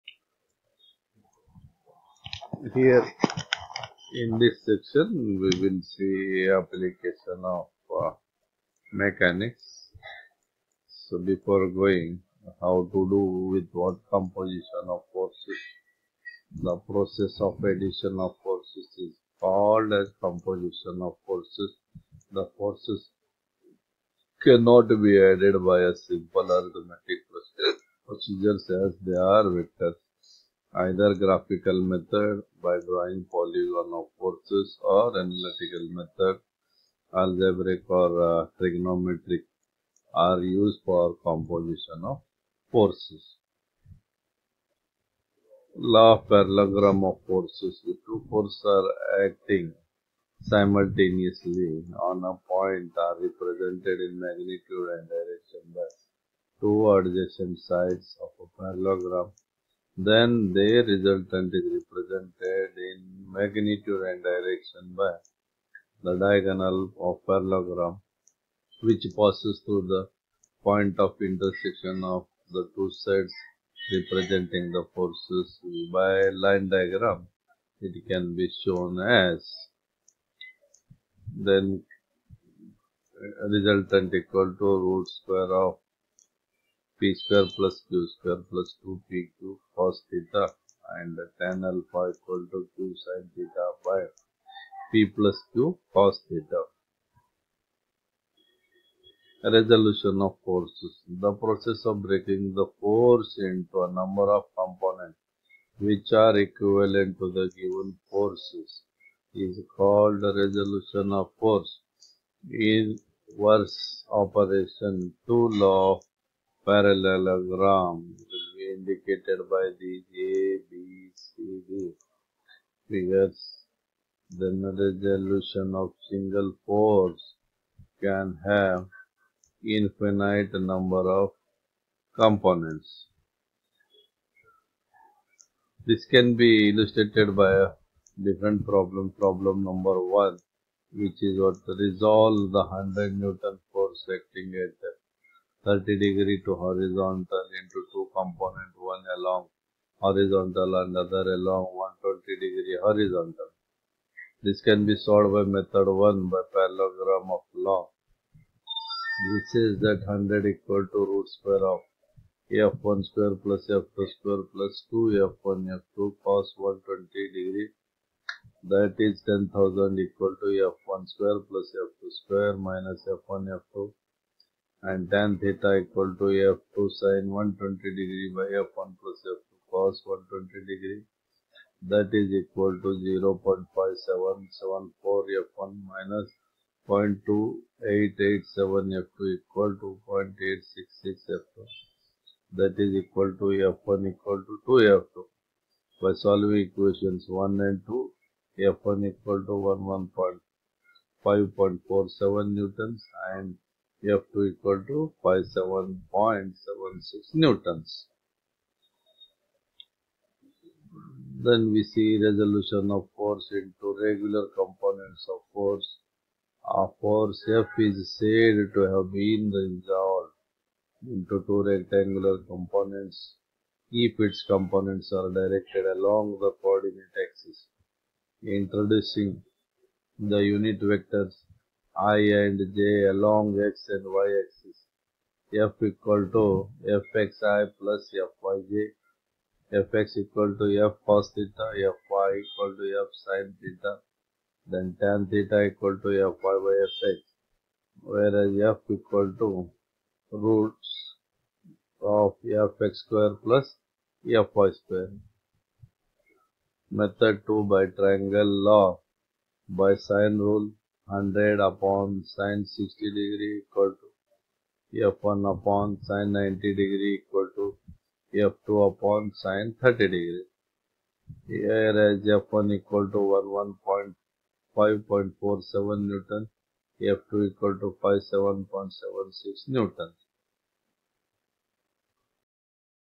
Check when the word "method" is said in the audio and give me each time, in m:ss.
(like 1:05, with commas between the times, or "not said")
0:31, 0:35, 2:35, 4:16.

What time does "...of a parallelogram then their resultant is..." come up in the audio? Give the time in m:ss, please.
0:58.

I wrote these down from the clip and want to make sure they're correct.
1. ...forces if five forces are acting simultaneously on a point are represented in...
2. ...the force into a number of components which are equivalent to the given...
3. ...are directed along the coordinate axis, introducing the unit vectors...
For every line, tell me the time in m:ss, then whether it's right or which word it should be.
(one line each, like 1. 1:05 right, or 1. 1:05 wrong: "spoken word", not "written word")
1. 0:47 wrong: "two", not "five"
2. 1:42 right
3. 3:45 right.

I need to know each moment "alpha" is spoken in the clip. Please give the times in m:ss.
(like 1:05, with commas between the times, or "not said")
1:31.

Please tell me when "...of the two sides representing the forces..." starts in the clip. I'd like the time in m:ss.
1:12.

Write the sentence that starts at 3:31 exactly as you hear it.
Then we see resolution of force into regular components of force.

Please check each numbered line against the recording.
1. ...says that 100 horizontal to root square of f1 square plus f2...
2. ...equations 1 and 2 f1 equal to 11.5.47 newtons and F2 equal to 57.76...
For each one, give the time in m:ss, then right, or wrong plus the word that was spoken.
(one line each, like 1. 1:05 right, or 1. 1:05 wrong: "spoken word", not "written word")
1. 2:39 wrong: "equal", not "horizontal"
2. 3:16 right.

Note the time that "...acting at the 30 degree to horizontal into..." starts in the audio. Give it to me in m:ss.
2:24.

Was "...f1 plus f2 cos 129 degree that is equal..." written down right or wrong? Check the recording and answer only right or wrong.
wrong.